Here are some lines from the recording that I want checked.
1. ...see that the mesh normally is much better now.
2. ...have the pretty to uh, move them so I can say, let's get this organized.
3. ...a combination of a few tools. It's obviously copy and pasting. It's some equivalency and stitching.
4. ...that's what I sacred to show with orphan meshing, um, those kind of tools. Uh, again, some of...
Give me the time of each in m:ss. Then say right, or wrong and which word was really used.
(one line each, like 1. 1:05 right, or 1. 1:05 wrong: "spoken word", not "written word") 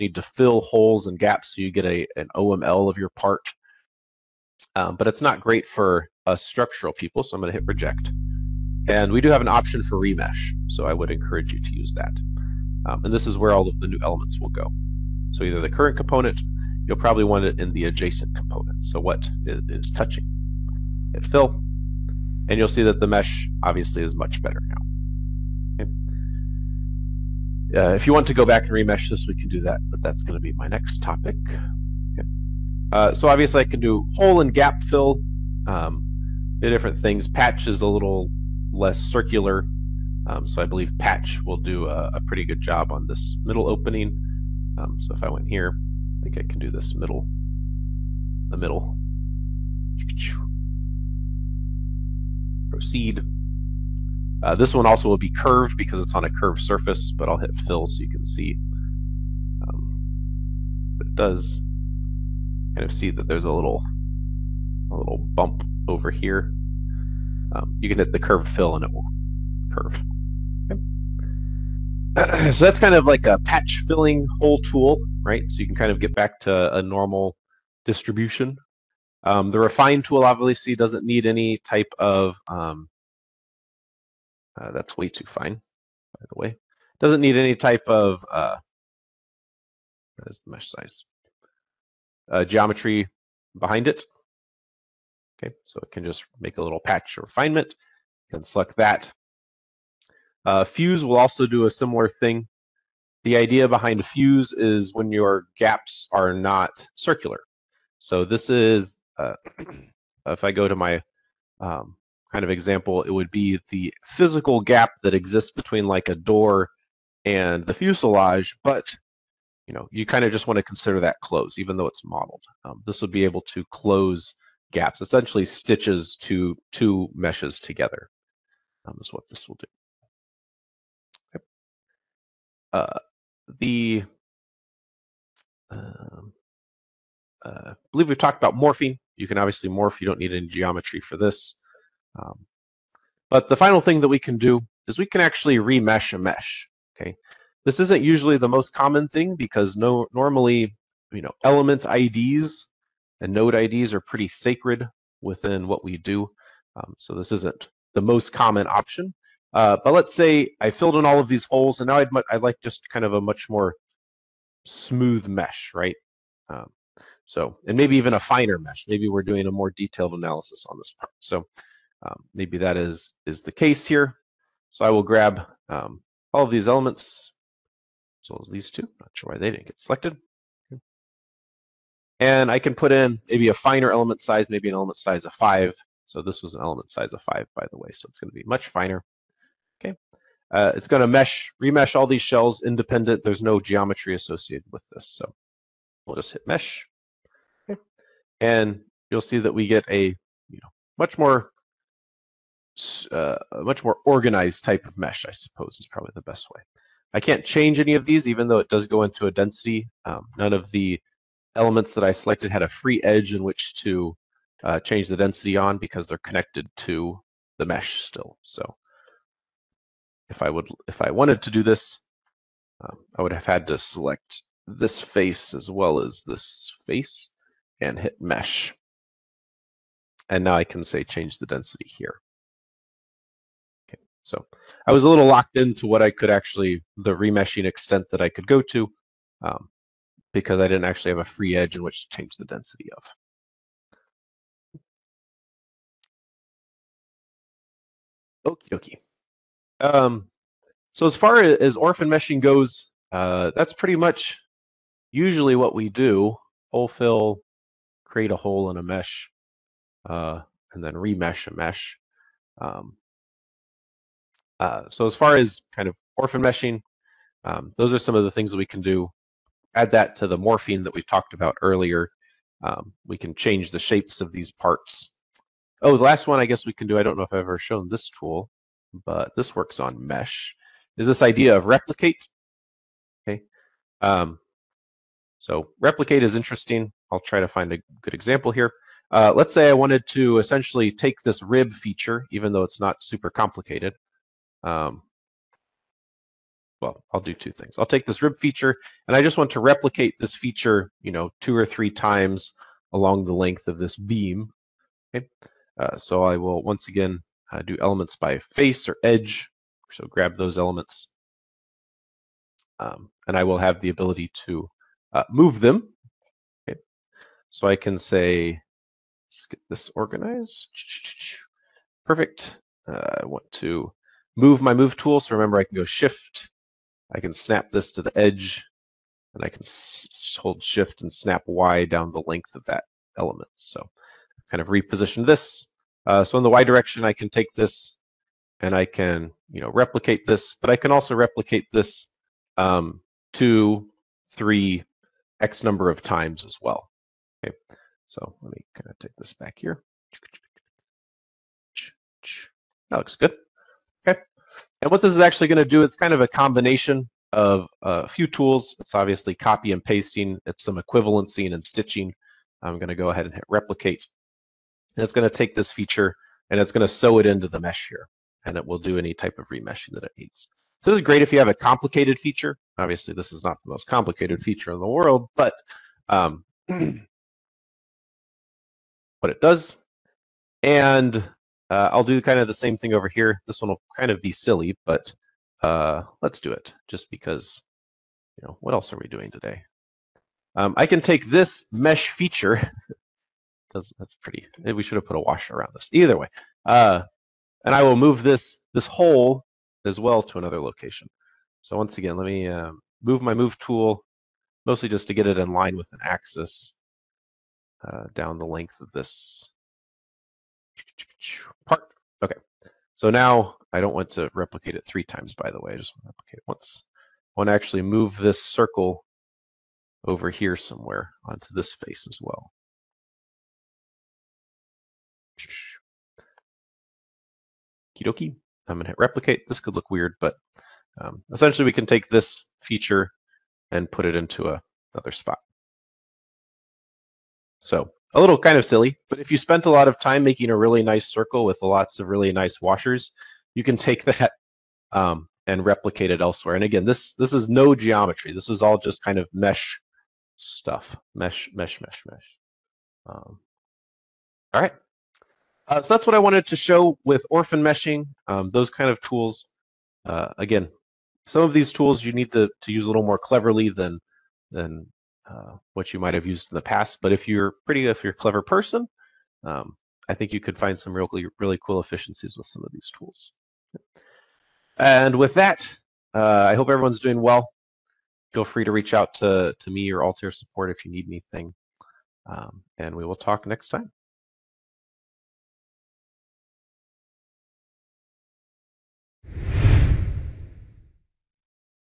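1. 0:22 wrong: "obviously", not "normally"
2. 5:13 wrong: "ability", not "pretty"
3. 5:56 right
4. 7:35 wrong: "wanted", not "sacred".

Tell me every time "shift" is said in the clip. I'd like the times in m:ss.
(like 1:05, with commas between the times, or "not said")
5:25, 5:30.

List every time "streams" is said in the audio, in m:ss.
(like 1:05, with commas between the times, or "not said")
not said.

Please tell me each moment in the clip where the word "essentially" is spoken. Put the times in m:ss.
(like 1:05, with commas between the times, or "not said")
2:05, 4:50, 7:11.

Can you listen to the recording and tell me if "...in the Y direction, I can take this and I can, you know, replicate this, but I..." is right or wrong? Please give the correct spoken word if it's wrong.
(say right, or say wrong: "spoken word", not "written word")
right.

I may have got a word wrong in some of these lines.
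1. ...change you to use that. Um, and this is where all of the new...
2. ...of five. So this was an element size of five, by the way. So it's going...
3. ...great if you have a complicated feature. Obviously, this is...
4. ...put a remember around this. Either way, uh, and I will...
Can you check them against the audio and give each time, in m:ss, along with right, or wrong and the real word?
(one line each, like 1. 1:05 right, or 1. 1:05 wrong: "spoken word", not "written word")
1. 0:11 wrong: "encourage", not "change"
2. 3:05 right
3. 6:11 right
4. 6:35 wrong: "washer", not "remember".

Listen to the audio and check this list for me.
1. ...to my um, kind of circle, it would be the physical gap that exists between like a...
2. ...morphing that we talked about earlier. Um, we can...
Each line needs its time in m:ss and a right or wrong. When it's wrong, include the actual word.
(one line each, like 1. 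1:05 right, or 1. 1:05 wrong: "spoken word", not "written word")
1. 1:50 wrong: "example", not "circle"
2. 4:30 right.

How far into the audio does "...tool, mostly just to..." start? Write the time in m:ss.
6:43.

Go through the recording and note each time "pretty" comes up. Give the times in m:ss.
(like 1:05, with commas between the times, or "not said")
0:42, 2:33, 4:13, 6:34, 7:47.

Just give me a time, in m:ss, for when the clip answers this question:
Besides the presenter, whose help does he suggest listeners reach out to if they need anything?
8:00.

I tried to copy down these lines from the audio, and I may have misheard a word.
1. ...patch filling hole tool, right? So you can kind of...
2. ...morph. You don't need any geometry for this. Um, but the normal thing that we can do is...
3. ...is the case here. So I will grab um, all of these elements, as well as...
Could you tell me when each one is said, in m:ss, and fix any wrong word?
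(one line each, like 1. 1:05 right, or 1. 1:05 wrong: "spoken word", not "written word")
1. 1:13 right
2. 2:19 wrong: "final", not "normal"
3. 2:53 right.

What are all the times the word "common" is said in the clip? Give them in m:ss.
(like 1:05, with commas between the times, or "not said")
2:28, 2:38.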